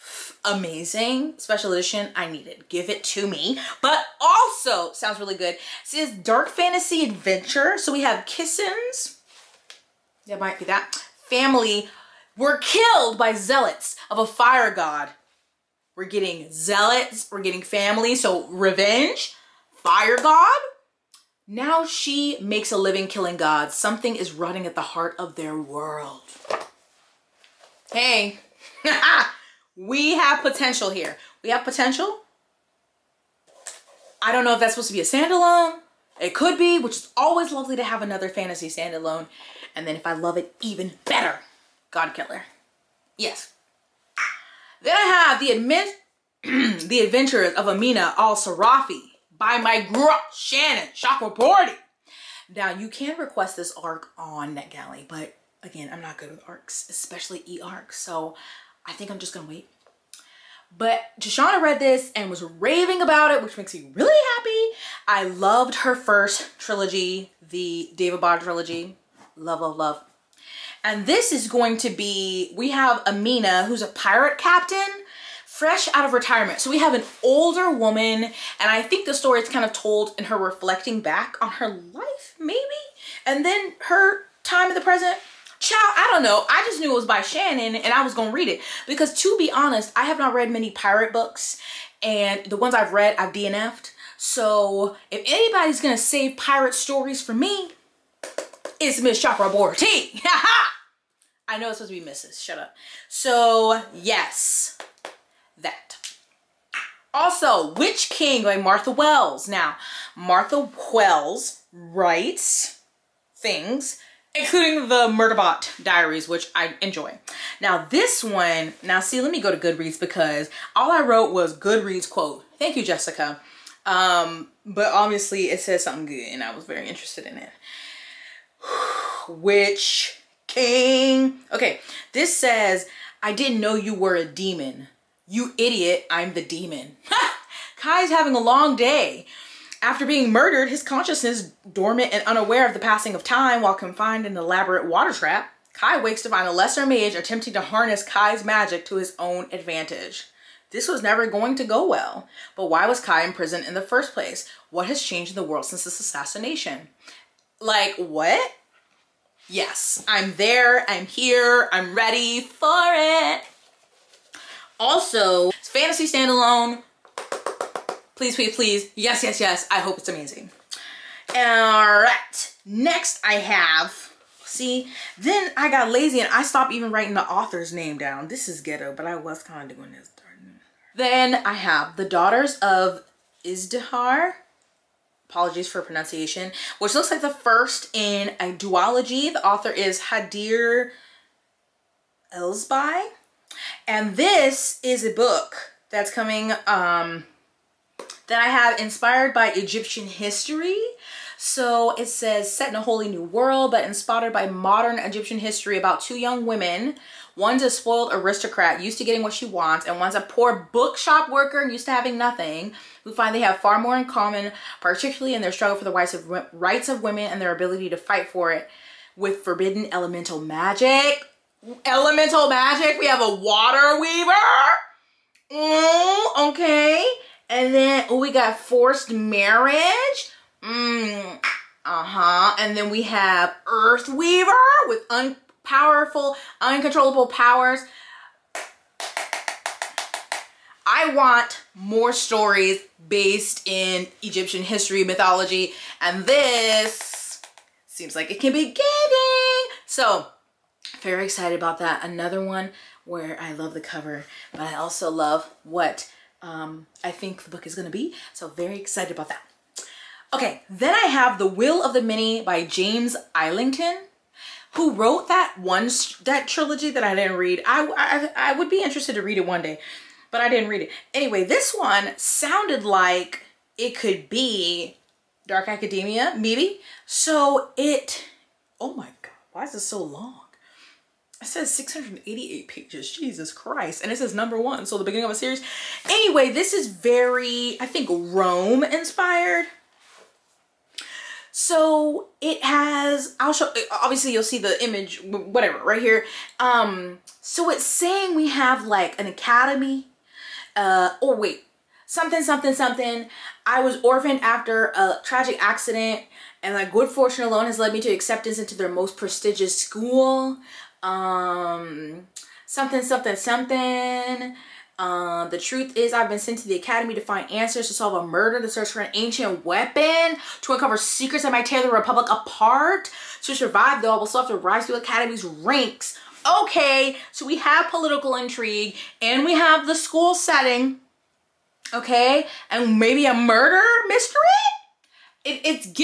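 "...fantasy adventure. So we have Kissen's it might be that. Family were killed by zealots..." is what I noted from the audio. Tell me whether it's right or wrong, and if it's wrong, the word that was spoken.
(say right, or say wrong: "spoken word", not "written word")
right.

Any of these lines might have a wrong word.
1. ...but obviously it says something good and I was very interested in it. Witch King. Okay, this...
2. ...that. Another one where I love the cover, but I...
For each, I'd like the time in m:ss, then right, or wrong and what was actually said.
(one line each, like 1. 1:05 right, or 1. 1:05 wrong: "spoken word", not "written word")
1. 2:04 right
2. 4:11 right.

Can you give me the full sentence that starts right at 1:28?
Because to be honest, I have not read many pirate books, and the ones I've read, I've DNF'd.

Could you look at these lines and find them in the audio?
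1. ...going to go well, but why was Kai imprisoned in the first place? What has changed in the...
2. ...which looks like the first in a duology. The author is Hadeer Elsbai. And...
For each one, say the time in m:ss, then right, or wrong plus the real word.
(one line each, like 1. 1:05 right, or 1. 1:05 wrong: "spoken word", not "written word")
1. 2:31 right
2. 3:06 right.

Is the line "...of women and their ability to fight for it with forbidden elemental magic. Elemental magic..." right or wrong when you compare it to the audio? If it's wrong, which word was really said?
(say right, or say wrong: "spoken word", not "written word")
right.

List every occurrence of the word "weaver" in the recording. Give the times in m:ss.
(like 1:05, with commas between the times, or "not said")
3:43, 3:54.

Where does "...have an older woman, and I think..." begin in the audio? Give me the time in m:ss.
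1:16.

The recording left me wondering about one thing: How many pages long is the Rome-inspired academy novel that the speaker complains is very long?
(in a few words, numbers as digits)
688.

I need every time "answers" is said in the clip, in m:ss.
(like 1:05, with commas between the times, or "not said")
5:17.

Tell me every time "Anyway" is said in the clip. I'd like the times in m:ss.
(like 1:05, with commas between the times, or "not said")
4:31, 4:46.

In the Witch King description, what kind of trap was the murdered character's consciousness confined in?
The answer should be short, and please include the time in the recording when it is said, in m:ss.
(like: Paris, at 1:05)
An elaborate water trap, at 2:24.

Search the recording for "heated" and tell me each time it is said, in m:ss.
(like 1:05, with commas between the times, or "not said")
not said.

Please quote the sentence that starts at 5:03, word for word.
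I was orphaned after a tragic accident and my good fortune alone has led me to acceptance into their most prestigious school.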